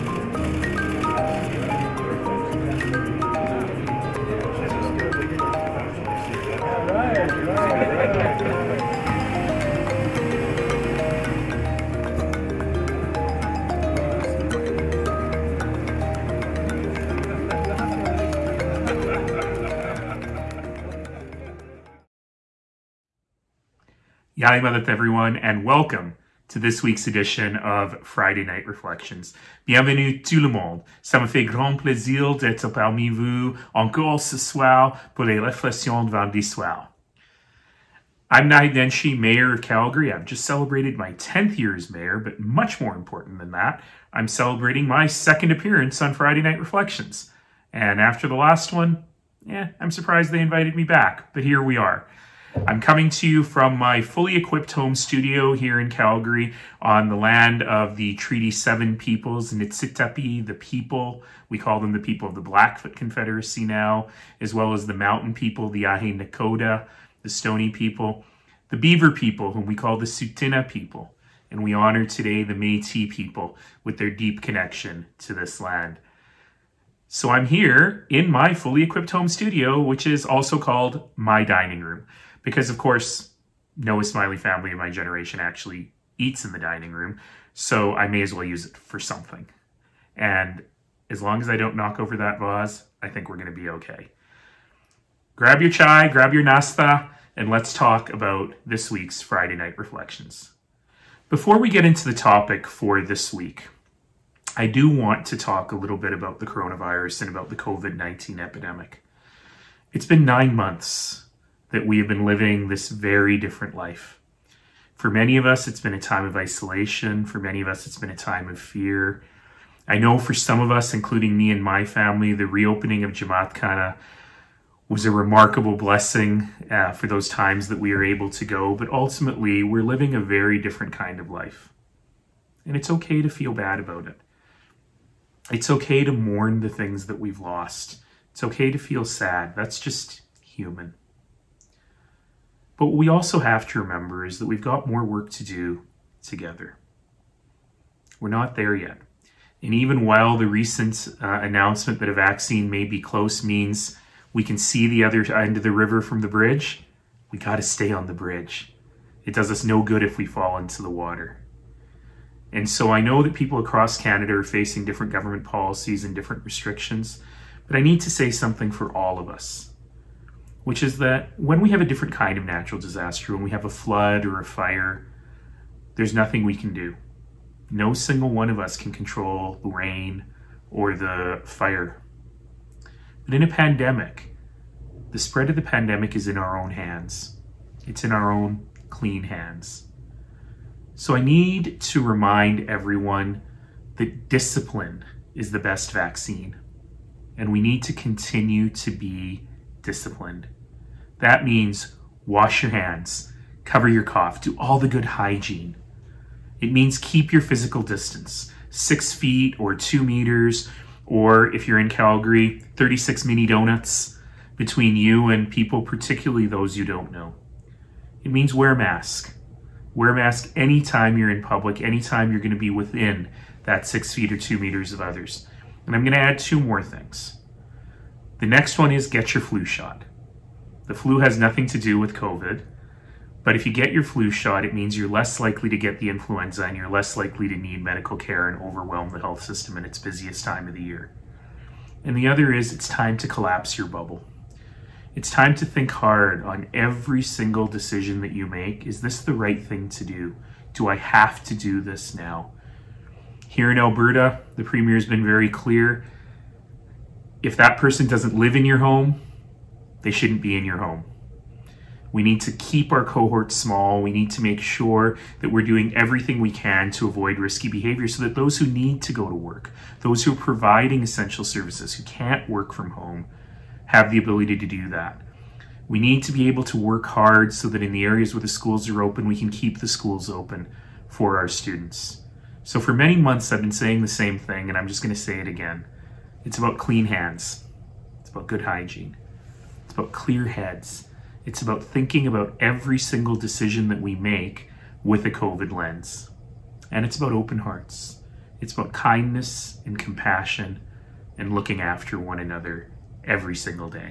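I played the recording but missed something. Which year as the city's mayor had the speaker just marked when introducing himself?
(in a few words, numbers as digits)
10th.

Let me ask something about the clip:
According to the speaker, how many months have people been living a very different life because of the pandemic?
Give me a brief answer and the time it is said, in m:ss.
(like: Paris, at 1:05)
9, at 1:50.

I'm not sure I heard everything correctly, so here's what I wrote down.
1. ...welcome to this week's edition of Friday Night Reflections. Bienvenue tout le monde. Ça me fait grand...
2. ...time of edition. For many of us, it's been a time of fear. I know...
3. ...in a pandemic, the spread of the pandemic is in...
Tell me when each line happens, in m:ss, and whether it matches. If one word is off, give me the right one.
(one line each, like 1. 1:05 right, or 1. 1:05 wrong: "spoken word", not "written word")
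1. 0:25 right
2. 1:55 wrong: "isolation", not "edition"
3. 3:03 right.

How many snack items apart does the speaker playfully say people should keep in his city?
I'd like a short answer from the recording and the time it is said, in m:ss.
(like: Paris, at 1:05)
36, at 3:32.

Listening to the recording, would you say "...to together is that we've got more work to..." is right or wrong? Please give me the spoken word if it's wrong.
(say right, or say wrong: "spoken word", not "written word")
wrong: "remember", not "together".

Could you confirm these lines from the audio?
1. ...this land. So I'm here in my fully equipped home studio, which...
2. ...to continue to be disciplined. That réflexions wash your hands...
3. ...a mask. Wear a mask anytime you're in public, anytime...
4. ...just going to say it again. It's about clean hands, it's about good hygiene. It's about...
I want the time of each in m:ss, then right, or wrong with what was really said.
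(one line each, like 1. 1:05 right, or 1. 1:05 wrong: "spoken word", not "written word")
1. 1:15 right
2. 3:17 wrong: "means", not "réflexions"
3. 3:38 right
4. 4:44 right.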